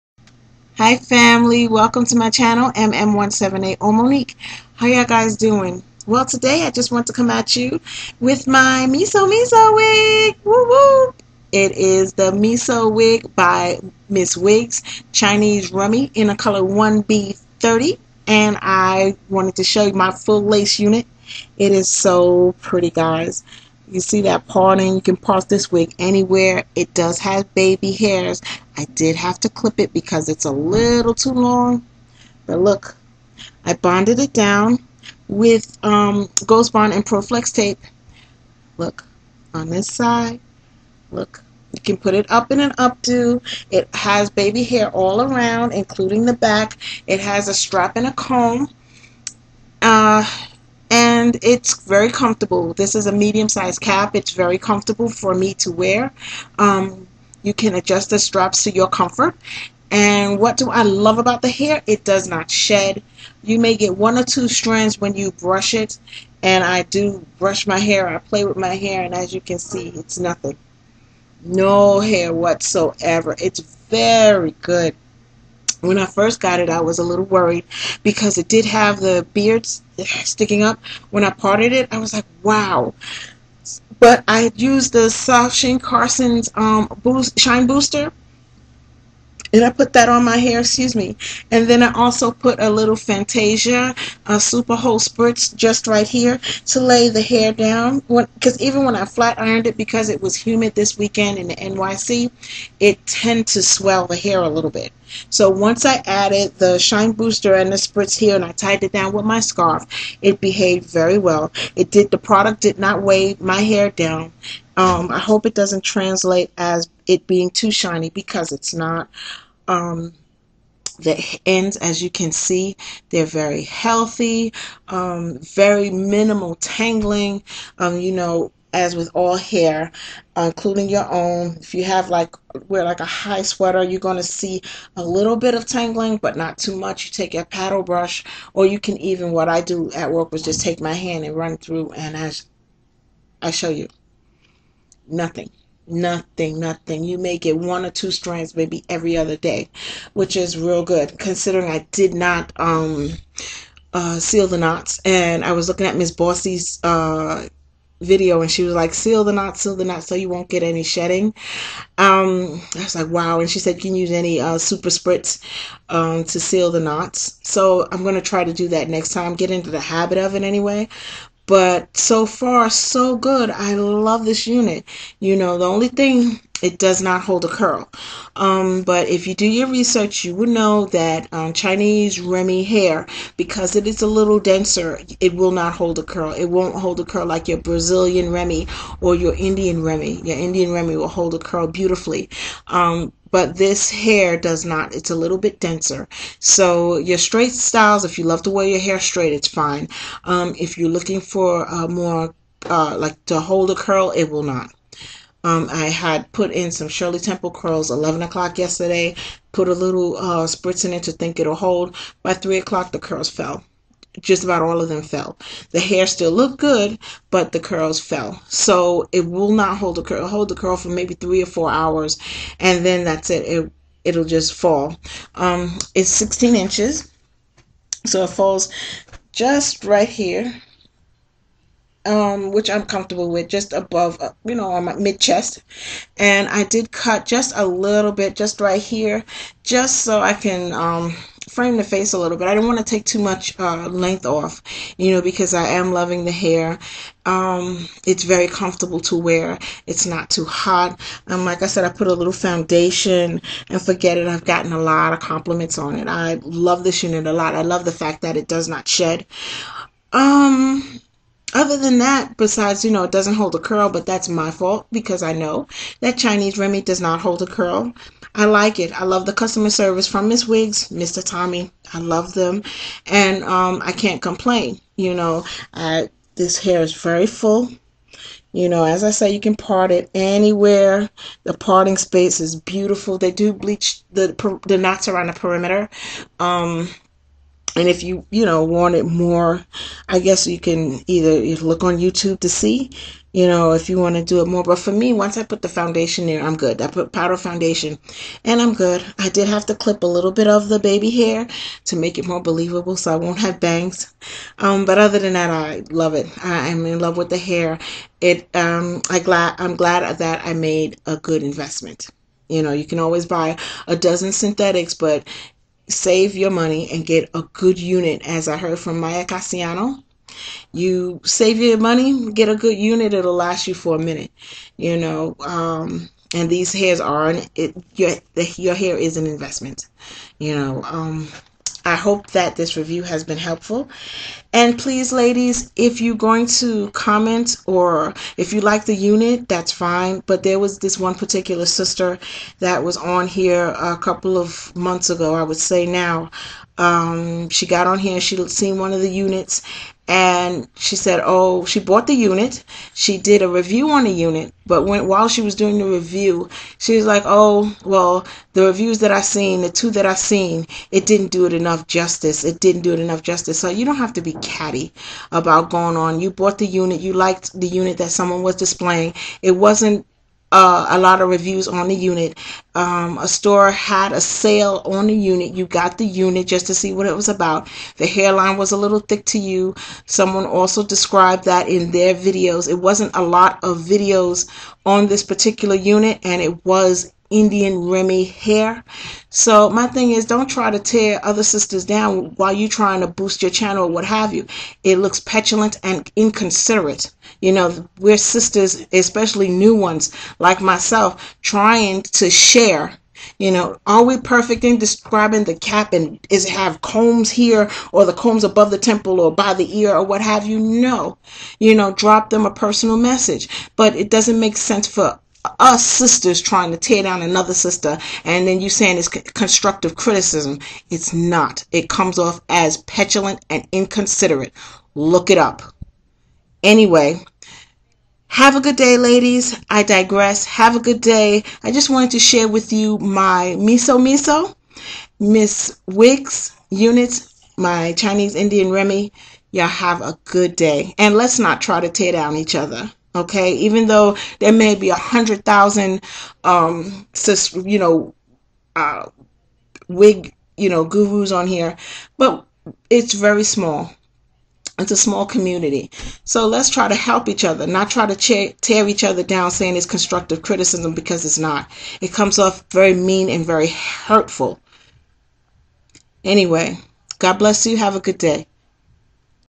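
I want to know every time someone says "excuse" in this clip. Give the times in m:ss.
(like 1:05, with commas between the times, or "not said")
1:30.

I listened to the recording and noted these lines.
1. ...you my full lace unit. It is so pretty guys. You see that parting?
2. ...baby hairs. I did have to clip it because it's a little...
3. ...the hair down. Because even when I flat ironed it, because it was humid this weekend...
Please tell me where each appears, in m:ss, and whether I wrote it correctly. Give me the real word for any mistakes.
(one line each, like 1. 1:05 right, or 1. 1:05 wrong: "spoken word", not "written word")
1. 0:19 right
2. 0:27 right
3. 1:37 right.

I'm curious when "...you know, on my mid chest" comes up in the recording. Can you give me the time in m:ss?
3:54.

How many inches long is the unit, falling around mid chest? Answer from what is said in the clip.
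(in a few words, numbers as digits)
16.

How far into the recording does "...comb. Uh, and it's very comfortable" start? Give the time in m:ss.
0:48.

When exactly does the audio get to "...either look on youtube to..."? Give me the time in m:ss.
4:51.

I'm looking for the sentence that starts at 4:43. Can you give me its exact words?
They do bleach the the knots around the perimeter.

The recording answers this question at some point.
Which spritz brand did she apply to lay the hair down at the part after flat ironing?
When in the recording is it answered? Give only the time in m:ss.
1:32.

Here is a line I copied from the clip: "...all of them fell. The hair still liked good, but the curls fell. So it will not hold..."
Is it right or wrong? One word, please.
wrong.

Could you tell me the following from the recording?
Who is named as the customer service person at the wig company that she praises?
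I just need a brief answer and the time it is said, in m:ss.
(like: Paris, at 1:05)
Mr. Tommy, at 4:30.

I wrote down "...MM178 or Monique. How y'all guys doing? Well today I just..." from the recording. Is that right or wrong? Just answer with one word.
right.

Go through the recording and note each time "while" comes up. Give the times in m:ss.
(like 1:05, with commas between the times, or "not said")
5:55, 6:32.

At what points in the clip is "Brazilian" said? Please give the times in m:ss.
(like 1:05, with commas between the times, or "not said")
3:07.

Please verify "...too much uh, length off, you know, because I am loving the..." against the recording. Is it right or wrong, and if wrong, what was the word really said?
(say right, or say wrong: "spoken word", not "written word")
right.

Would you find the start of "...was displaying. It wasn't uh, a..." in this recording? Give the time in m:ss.
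6:08.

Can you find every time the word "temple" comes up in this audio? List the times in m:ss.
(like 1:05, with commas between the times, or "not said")
3:27, 6:48.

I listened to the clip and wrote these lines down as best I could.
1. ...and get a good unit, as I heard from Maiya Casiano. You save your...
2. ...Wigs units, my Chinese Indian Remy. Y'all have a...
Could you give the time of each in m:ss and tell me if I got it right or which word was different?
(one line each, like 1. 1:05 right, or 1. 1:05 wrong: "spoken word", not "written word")
1. 5:16 right
2. 7:15 right.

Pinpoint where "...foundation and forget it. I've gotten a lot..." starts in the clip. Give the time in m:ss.
4:12.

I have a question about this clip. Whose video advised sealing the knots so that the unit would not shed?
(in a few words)
Miss Bossy.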